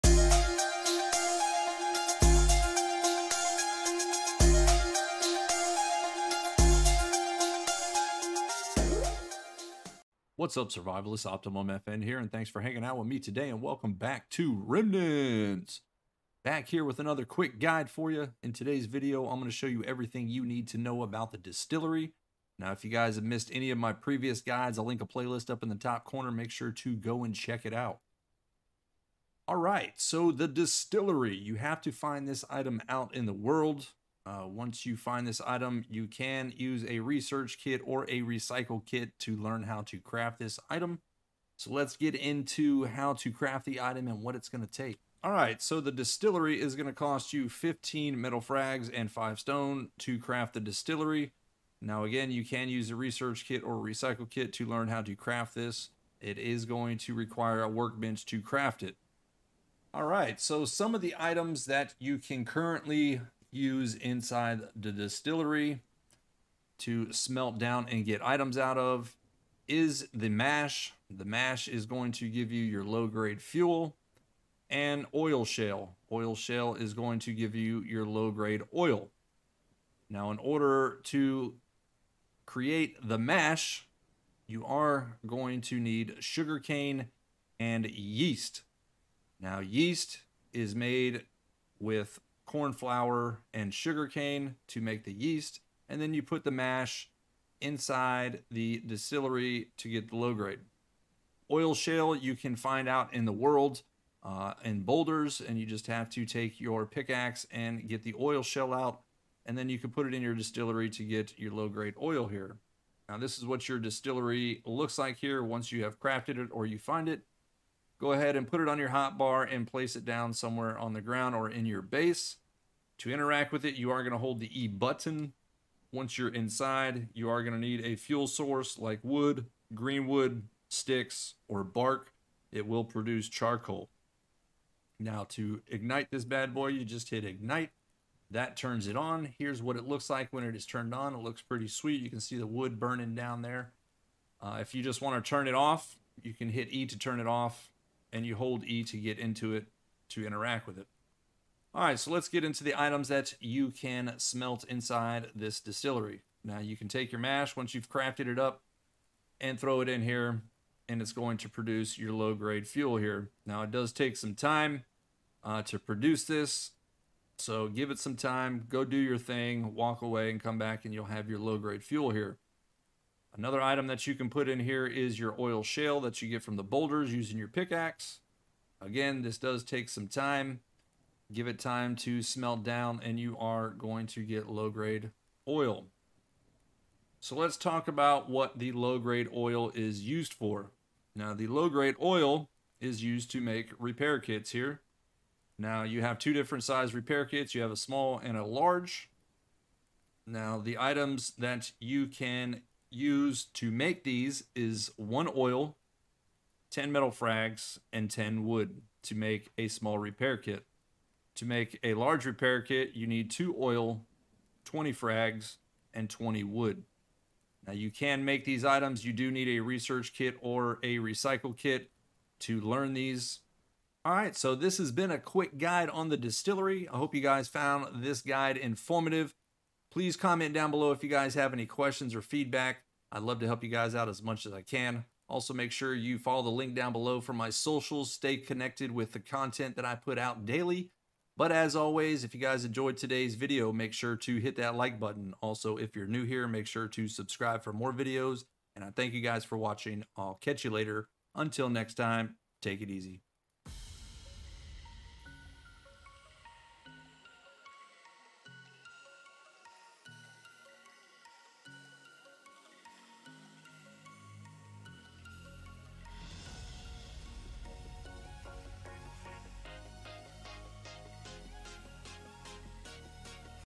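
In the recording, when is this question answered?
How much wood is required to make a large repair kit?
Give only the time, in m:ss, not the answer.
3:36.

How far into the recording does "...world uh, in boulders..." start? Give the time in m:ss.
1:43.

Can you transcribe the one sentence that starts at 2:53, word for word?
Another item that you can put in here is your oil shale that you get from the boulders using your pickaxe.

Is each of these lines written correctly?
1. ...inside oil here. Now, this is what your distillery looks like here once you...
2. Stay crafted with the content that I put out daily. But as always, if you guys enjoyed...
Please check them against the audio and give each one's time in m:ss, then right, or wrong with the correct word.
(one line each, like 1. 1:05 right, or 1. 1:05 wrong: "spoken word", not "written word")
1. 1:51 wrong: "grade", not "inside"
2. 3:58 wrong: "connected", not "crafted".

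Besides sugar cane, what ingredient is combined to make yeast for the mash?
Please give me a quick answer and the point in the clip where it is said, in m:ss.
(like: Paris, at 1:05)
corn flour, at 1:32.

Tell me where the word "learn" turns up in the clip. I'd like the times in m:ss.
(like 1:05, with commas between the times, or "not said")
0:39, 0:54, 3:42.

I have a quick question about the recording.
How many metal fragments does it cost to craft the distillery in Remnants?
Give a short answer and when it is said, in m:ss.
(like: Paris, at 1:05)
15, at 0:47.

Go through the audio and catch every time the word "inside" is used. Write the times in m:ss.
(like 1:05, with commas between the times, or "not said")
1:03, 1:37, 2:06, 2:34.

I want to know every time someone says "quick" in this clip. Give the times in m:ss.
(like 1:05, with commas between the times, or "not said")
0:17, 3:45.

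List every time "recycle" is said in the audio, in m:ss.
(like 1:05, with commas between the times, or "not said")
0:38, 0:53, 3:40.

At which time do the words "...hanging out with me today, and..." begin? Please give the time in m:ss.
0:12.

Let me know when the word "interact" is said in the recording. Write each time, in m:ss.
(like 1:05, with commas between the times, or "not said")
2:03, 2:30.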